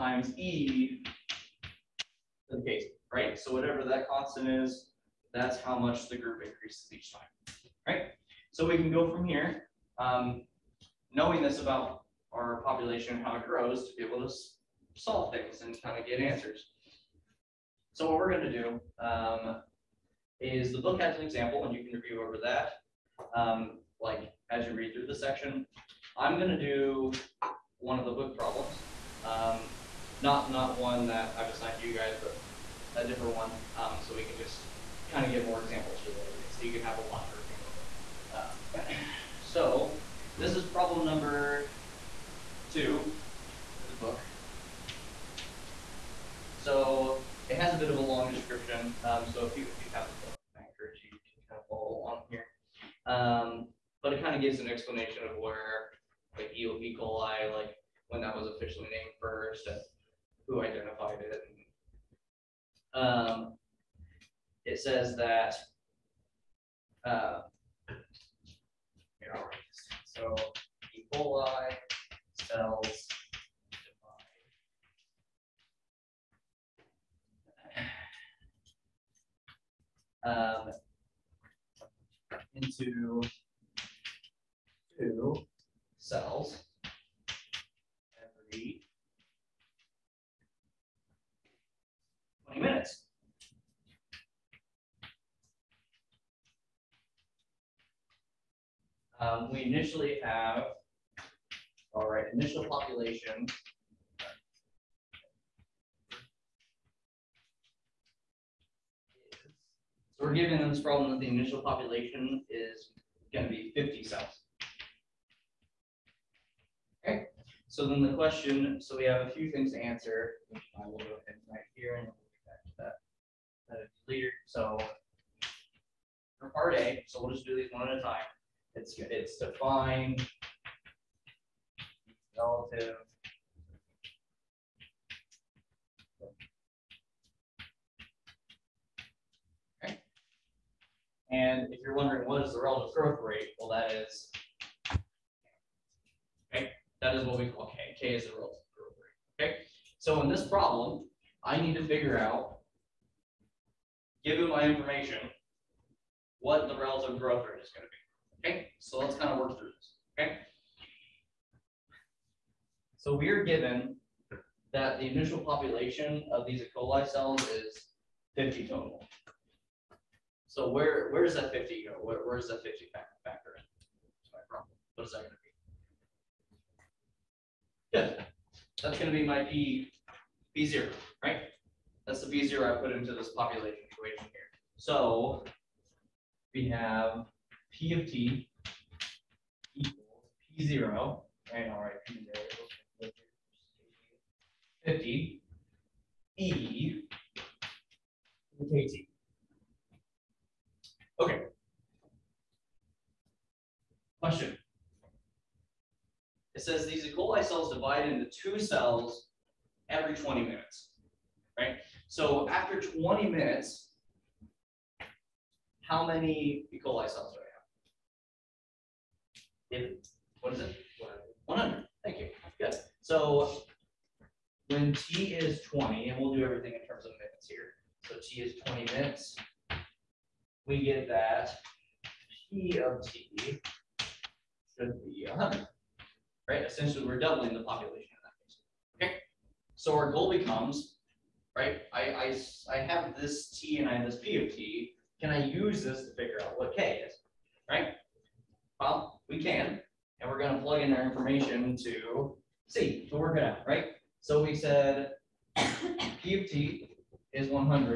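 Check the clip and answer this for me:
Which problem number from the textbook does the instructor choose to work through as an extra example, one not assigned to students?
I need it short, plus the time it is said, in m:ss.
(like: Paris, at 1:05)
2, at 0:40.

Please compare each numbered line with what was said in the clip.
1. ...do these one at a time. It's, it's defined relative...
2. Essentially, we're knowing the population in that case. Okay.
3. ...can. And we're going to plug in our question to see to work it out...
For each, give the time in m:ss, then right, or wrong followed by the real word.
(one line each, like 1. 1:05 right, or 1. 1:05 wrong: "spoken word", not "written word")
1. 2:07 right
2. 3:56 wrong: "doubling", not "knowing"
3. 4:09 wrong: "information", not "question".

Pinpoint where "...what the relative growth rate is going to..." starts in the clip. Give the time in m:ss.
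2:36.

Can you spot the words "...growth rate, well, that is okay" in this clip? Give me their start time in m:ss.
2:22.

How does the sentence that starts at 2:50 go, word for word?
So where where does that 50 go?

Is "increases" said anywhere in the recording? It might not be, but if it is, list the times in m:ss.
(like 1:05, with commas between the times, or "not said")
0:06.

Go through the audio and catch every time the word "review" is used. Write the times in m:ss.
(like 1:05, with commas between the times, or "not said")
0:21, 0:37.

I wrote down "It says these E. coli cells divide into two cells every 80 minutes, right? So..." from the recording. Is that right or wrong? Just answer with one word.
wrong.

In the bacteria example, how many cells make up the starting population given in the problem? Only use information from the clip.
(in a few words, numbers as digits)
50.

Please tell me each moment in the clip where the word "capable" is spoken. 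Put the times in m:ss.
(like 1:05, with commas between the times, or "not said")
not said.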